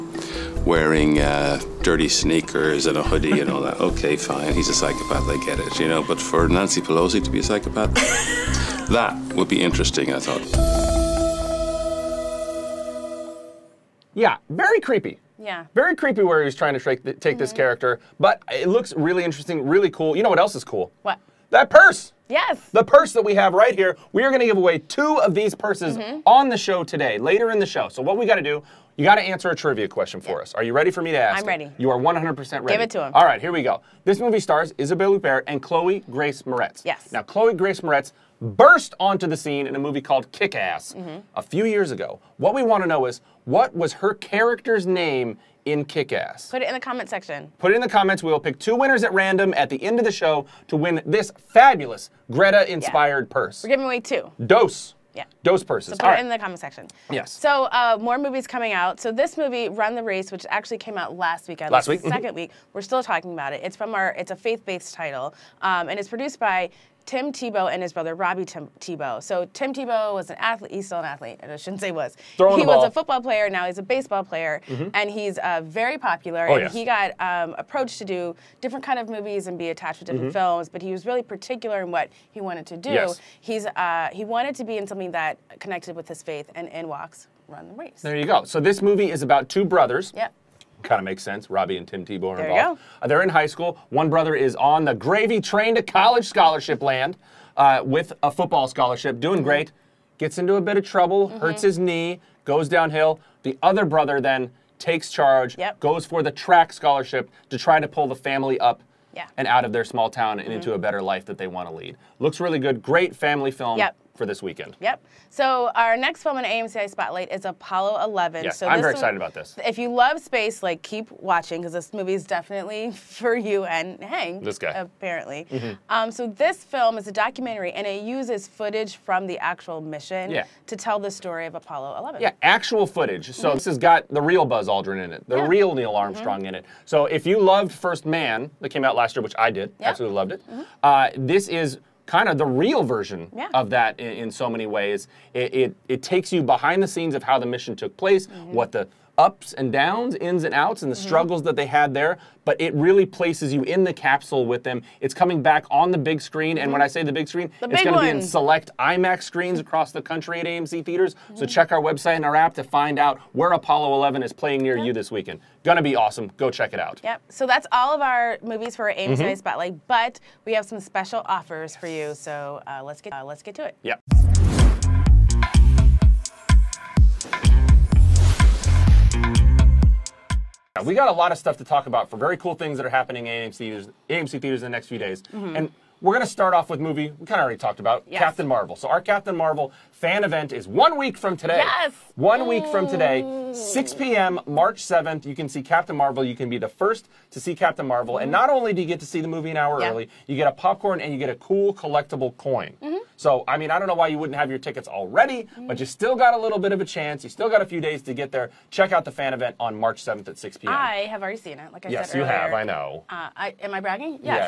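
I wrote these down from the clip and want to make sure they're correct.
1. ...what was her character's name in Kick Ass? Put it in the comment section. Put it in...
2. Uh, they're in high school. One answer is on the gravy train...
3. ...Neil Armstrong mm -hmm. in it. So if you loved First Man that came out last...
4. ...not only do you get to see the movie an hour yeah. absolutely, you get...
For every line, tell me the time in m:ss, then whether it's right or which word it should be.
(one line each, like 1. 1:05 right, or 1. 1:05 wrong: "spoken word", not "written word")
1. 0:43 right
2. 1:33 wrong: "brother", not "answer"
3. 2:15 right
4. 3:18 wrong: "early", not "absolutely".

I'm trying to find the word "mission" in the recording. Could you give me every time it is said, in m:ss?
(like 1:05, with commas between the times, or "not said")
2:09, 2:27.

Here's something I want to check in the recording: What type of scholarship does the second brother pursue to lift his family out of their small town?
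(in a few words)
track.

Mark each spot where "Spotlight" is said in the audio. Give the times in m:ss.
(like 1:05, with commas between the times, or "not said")
1:56, 2:49.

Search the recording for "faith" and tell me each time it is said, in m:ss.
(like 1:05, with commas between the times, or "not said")
1:04, 1:26.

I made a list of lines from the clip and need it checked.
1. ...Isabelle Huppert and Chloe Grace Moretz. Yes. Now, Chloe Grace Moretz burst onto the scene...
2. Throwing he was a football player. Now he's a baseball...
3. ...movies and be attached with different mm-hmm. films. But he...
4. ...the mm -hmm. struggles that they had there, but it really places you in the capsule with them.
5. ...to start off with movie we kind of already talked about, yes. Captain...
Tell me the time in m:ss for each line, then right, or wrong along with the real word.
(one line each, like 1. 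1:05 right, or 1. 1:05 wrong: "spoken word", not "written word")
1. 0:34 right
2. 1:12 right
3. 1:19 right
4. 2:30 right
5. 3:06 right.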